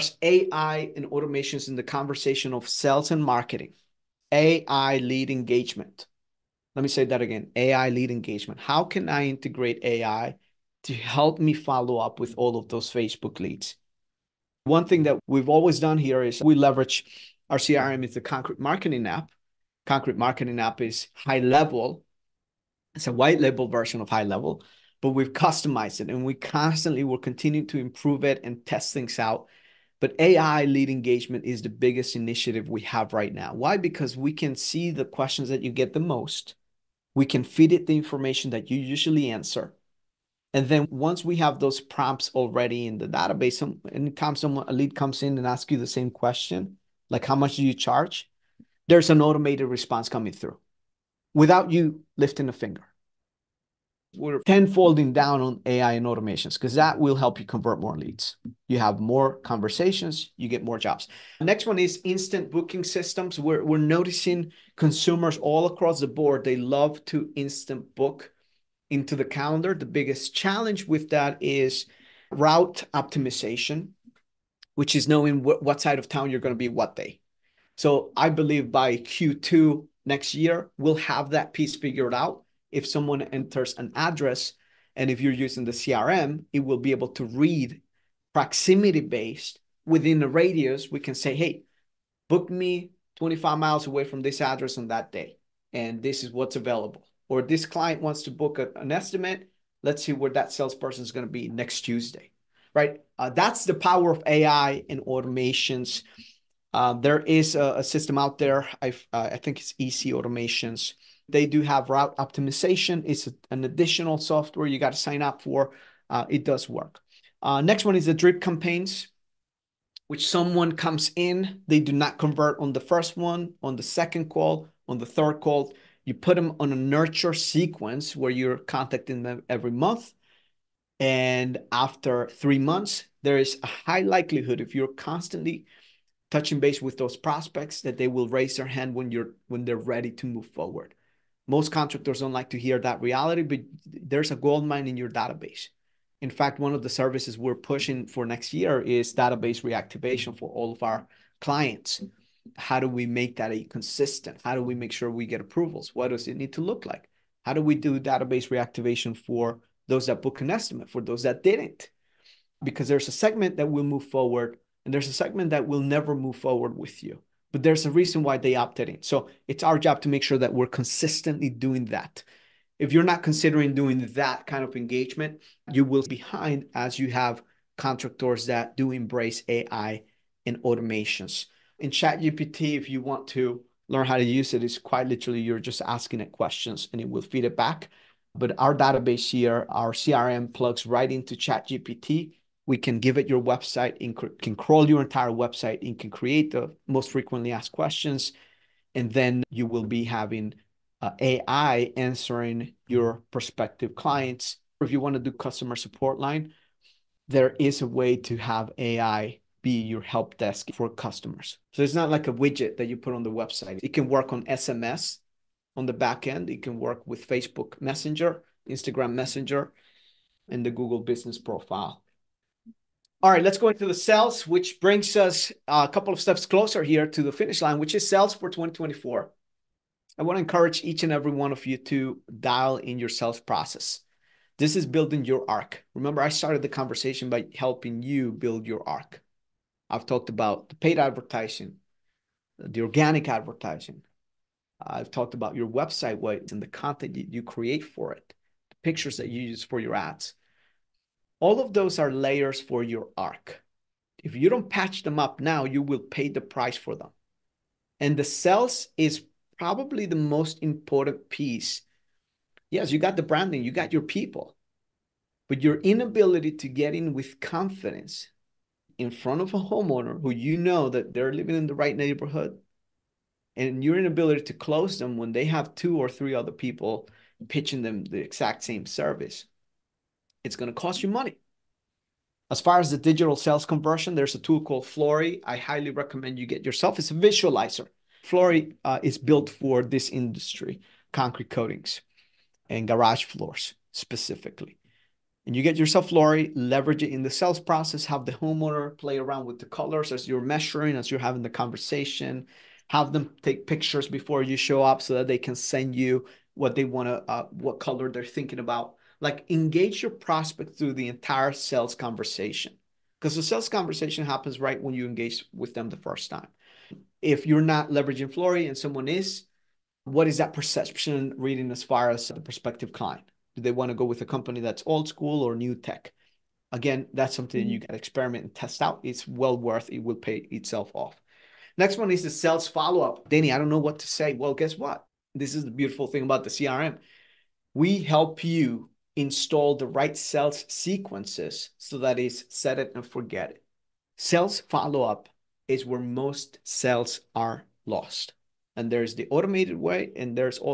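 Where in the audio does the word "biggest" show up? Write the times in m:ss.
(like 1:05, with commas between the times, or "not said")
0:31, 1:09.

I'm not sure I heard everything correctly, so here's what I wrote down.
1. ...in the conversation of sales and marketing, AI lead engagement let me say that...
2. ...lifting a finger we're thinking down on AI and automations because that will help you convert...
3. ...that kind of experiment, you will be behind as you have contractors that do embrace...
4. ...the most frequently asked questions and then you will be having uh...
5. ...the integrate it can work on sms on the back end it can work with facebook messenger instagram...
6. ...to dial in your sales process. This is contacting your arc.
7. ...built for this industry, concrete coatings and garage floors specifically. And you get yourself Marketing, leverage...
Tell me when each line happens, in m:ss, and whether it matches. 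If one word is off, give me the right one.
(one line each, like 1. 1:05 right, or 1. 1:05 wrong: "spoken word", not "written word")
1. 0:01 right
2. 0:52 wrong: "tenfolding", not "thinking"
3. 2:54 wrong: "engagement", not "experiment"
4. 3:16 right
5. 3:33 wrong: "website", not "integrate"
6. 3:51 wrong: "building", not "contacting"
7. 4:49 wrong: "Floori", not "Marketing".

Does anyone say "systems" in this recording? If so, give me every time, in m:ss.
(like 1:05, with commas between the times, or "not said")
1:02, 1:47.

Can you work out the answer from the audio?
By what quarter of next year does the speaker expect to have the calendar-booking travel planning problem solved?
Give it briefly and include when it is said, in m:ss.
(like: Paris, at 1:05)
Q2, at 1:18.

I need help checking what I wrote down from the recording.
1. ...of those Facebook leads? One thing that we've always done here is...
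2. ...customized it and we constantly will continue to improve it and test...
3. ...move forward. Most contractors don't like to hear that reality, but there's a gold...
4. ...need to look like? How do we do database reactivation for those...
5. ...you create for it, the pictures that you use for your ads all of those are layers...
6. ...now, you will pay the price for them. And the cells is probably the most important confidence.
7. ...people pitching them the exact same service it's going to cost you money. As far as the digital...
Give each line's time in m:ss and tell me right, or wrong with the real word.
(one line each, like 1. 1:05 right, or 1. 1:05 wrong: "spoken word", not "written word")
1. 0:12 right
2. 0:25 right
3. 2:20 right
4. 2:36 right
5. 4:07 right
6. 4:15 wrong: "piece", not "confidence"
7. 4:36 right.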